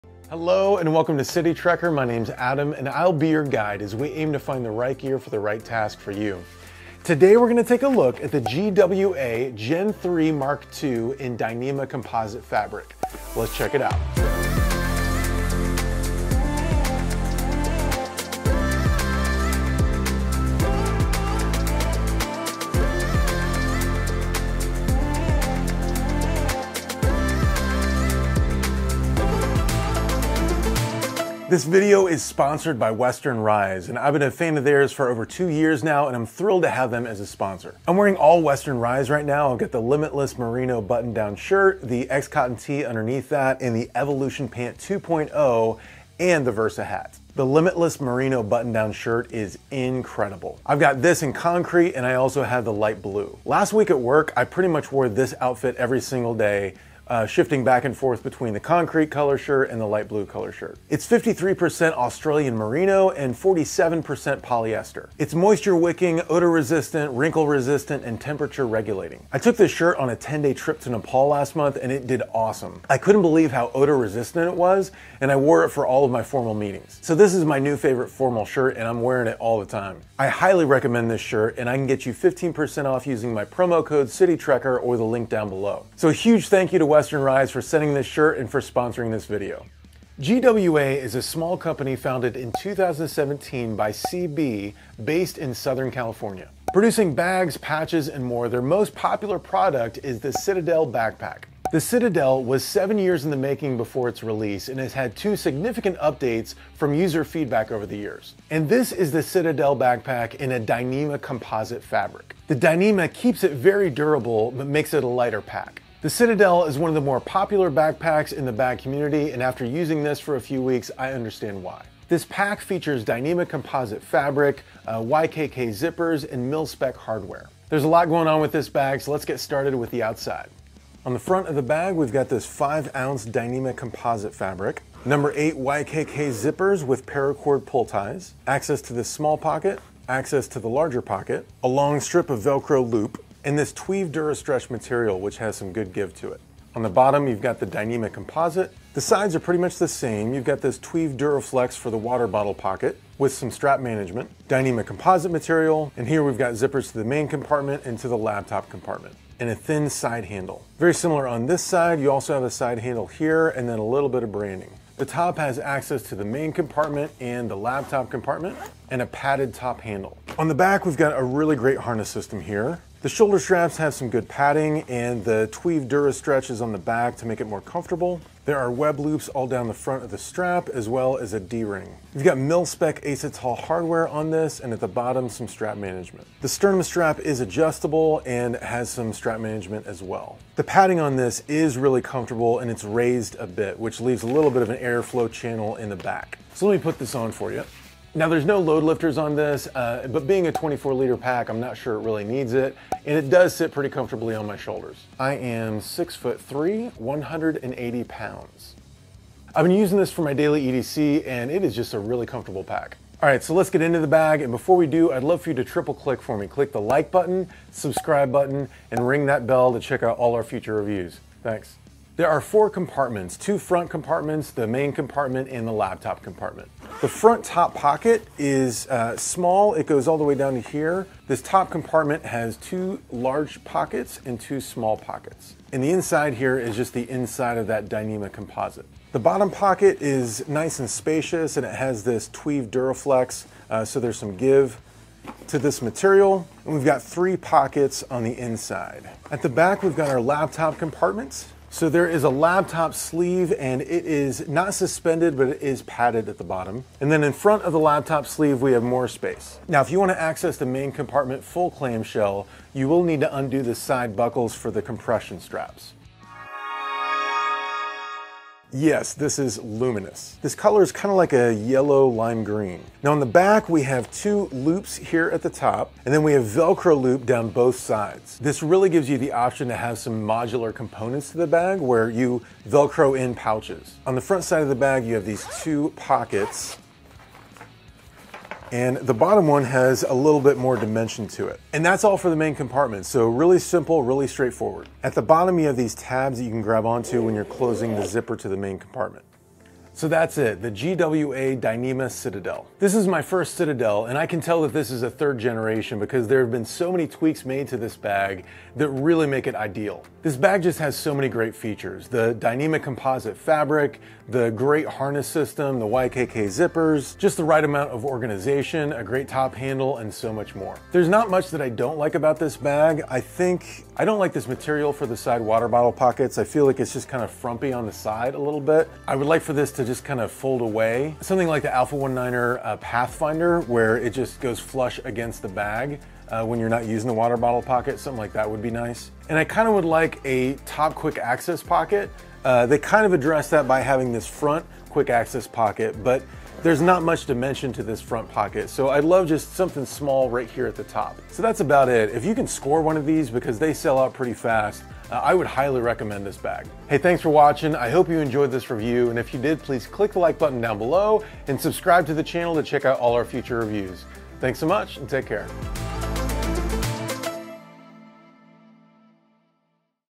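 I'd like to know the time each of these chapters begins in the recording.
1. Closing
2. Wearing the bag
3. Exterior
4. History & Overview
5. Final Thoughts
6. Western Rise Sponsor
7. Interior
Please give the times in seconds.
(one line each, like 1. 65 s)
1. 356 s
2. 196 s
3. 130 s
4. 89 s
5. 299 s
6. 31 s
7. 222 s.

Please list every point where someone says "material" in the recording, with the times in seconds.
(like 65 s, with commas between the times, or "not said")
144 s, 155 s, 245 s, 324 s.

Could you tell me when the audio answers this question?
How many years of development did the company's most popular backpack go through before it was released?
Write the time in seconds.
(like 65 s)
102 s.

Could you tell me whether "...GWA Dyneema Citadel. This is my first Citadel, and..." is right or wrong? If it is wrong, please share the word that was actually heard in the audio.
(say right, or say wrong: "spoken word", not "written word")
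right.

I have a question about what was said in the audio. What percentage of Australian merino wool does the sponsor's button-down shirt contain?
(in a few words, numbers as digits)
53%.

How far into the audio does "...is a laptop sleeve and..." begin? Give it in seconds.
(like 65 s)
252 s.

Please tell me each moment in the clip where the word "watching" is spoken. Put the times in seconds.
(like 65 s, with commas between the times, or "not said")
357 s.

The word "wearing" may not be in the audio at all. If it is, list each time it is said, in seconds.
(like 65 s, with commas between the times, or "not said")
37 s, 79 s.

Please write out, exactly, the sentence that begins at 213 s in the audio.
All right, so let's get into the bag.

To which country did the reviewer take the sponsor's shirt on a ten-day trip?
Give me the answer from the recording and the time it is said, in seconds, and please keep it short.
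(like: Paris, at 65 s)
Nepal, at 70 s.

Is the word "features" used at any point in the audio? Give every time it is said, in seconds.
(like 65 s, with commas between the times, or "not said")
122 s, 311 s.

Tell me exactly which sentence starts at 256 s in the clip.
And then in front of the laptop sleeve, we have more space.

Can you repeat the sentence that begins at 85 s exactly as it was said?
So a huge thank you to West Western Rise for sending this shirt and for sponsoring this video.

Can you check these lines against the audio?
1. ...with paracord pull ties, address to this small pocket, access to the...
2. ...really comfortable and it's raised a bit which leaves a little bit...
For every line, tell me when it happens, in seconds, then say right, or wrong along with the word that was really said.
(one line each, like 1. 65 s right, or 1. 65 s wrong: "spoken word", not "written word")
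1. 136 s wrong: "access", not "address"
2. 191 s right.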